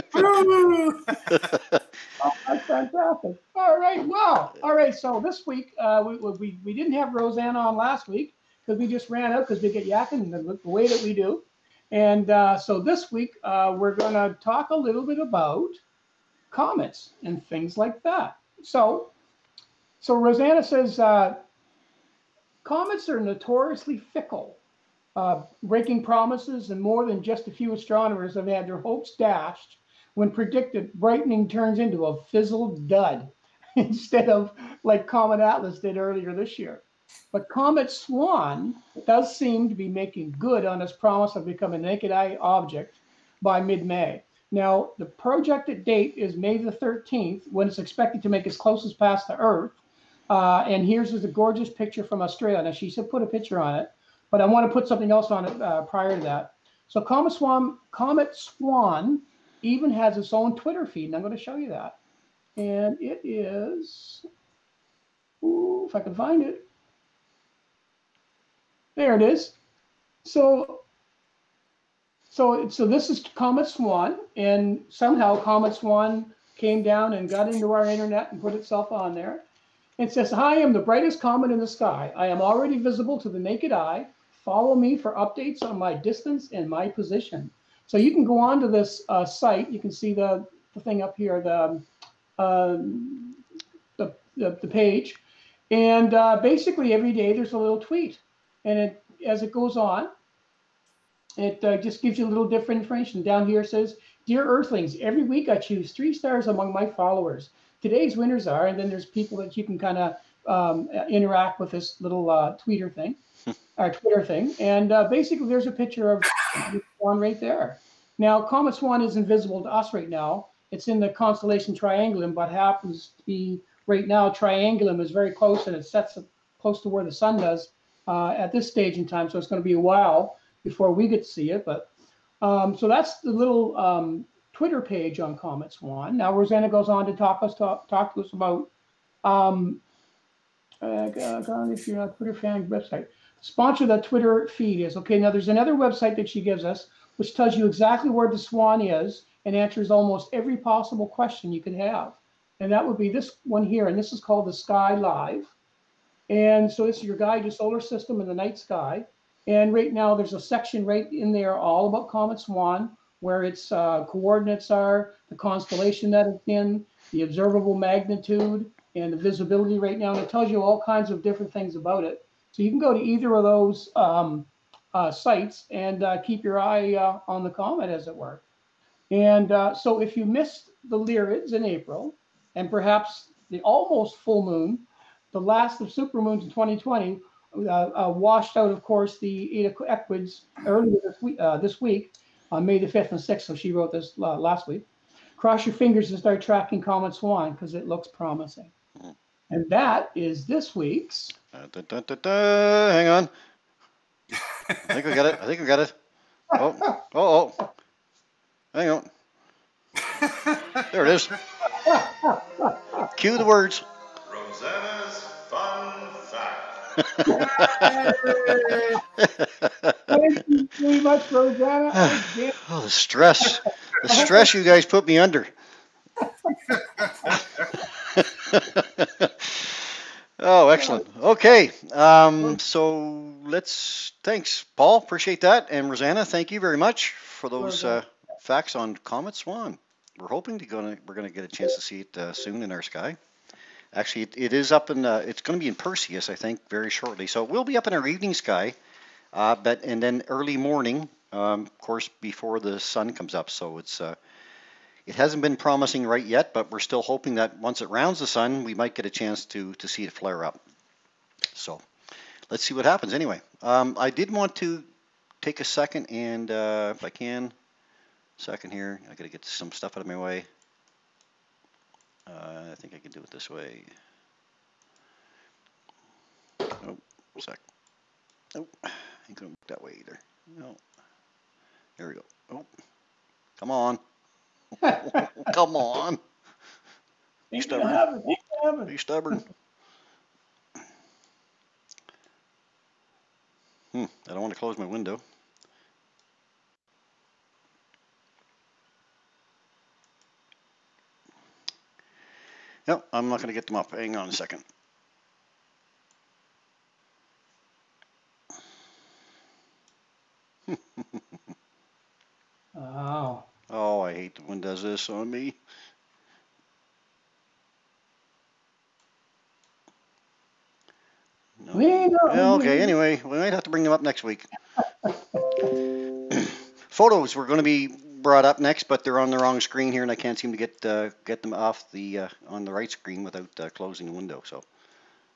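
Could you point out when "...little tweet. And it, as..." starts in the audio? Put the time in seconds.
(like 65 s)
97 s.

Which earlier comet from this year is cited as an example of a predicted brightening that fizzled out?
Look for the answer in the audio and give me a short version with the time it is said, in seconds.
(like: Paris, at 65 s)
Comet Atlas, at 35 s.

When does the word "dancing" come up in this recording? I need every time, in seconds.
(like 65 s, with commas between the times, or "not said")
not said.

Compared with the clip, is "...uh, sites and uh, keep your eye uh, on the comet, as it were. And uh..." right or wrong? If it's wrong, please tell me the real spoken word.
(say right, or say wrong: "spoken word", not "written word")
right.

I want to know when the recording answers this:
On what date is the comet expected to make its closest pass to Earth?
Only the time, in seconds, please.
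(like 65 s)
46 s.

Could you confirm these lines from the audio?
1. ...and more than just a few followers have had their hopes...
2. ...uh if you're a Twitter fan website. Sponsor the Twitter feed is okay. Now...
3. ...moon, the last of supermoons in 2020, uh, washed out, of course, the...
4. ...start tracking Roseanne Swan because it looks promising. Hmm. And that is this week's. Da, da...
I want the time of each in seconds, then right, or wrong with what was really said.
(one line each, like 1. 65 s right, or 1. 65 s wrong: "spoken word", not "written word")
1. 26 s wrong: "astronomers", not "followers"
2. 141 s right
3. 184 s right
4. 196 s wrong: "Comet", not "Roseanne".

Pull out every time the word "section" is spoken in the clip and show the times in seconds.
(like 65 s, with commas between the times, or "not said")
160 s.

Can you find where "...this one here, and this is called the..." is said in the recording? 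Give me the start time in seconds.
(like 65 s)
153 s.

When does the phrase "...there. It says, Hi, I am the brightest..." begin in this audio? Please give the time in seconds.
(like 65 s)
79 s.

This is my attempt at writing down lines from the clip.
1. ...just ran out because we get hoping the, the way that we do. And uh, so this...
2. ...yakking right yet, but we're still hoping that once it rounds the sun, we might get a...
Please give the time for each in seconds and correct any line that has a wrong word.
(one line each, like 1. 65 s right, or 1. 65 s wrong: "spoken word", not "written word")
1. 8 s wrong: "yakking", not "hoping"
2. 255 s wrong: "promising", not "yakking".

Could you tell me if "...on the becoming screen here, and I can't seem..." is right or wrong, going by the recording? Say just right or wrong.
wrong.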